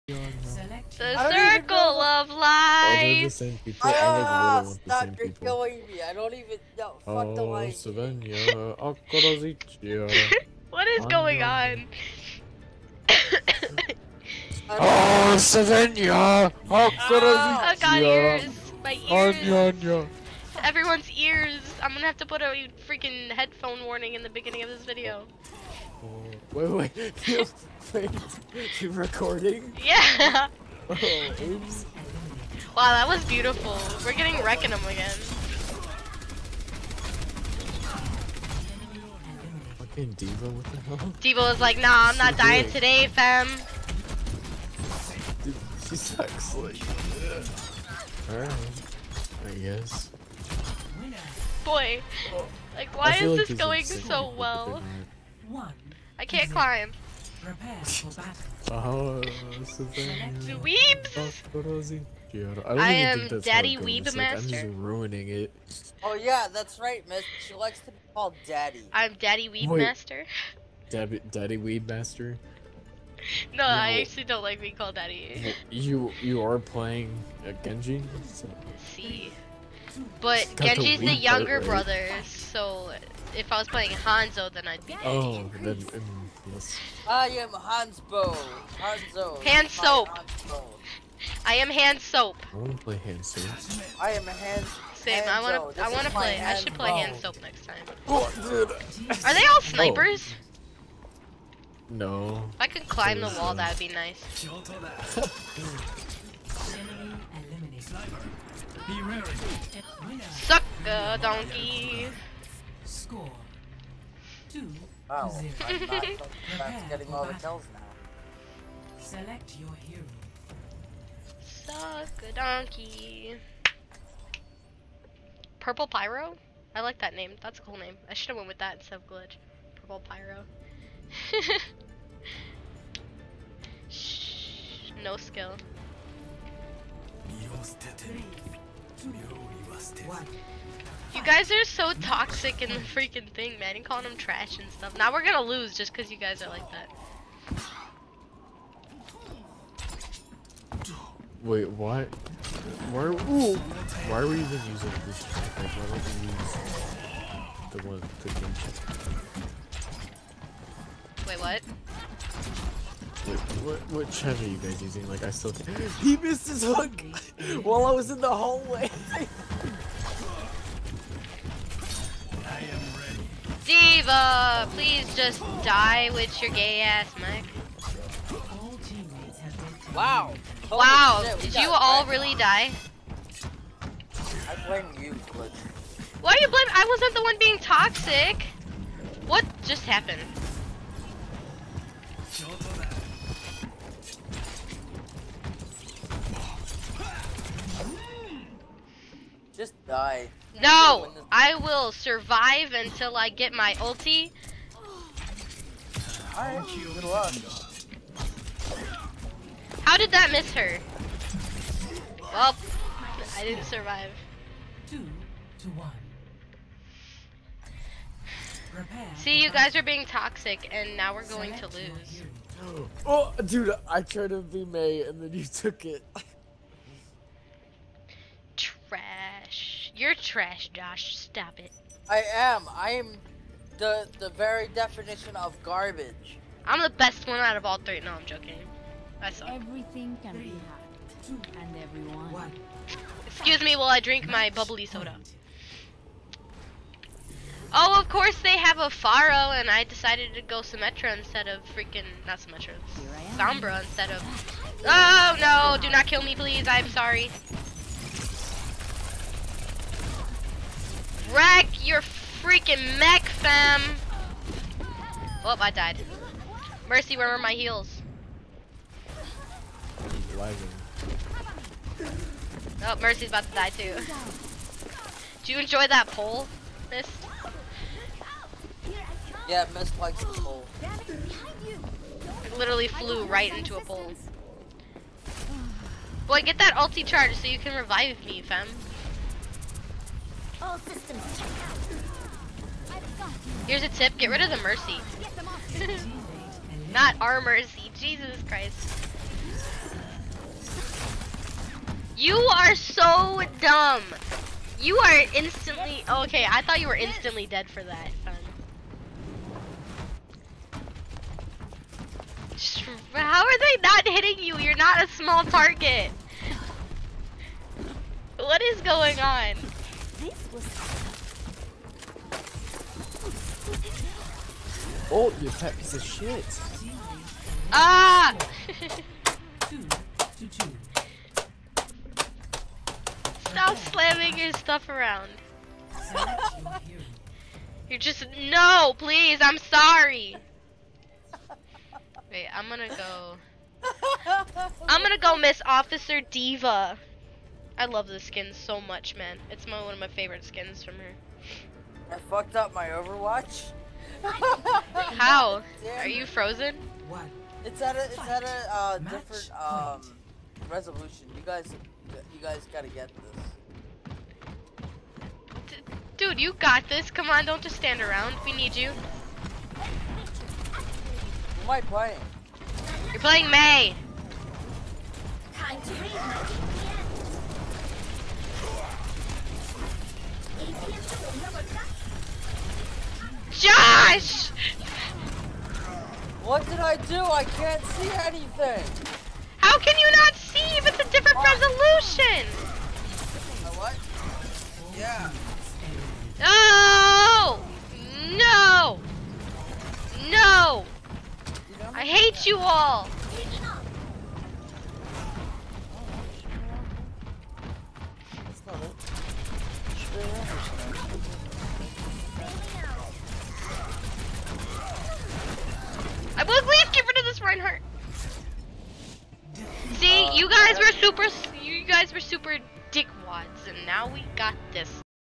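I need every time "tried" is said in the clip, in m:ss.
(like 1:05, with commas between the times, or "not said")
3:44.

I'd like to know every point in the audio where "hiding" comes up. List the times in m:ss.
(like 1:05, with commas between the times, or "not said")
not said.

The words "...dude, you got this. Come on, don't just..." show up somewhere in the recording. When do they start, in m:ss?
6:06.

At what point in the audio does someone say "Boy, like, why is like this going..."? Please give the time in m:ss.
0:51.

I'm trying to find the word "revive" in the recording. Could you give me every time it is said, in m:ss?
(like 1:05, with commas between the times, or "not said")
4:47.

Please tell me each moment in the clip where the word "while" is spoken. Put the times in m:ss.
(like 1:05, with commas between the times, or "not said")
2:47, 4:03.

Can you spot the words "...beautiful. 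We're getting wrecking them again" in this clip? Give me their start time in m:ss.
0:33.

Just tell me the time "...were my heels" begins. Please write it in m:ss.
4:27.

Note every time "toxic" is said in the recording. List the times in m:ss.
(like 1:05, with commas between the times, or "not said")
2:22, 3:07, 3:40.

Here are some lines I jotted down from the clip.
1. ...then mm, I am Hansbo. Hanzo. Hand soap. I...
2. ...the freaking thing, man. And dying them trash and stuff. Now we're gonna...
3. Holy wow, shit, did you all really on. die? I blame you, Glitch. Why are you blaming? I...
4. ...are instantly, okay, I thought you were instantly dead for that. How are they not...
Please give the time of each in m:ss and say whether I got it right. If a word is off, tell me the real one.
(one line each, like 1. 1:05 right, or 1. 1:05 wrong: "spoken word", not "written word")
1. 1:25 right
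2. 2:22 wrong: "calling", not "dying"
3. 3:00 right
4. 5:04 right.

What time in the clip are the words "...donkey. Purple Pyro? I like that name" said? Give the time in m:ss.
2:02.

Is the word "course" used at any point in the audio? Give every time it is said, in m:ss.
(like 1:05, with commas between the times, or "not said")
4:08.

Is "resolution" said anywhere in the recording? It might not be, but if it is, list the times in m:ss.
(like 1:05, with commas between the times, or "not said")
6:00, 6:31.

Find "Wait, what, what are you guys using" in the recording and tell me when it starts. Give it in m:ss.
2:43.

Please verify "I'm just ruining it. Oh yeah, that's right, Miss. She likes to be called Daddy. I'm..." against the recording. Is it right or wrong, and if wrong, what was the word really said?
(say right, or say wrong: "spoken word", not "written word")
right.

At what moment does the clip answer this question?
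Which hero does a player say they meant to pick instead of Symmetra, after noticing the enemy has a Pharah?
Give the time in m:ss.
4:13.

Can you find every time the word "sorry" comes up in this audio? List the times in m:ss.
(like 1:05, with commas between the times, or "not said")
4:16, 5:39.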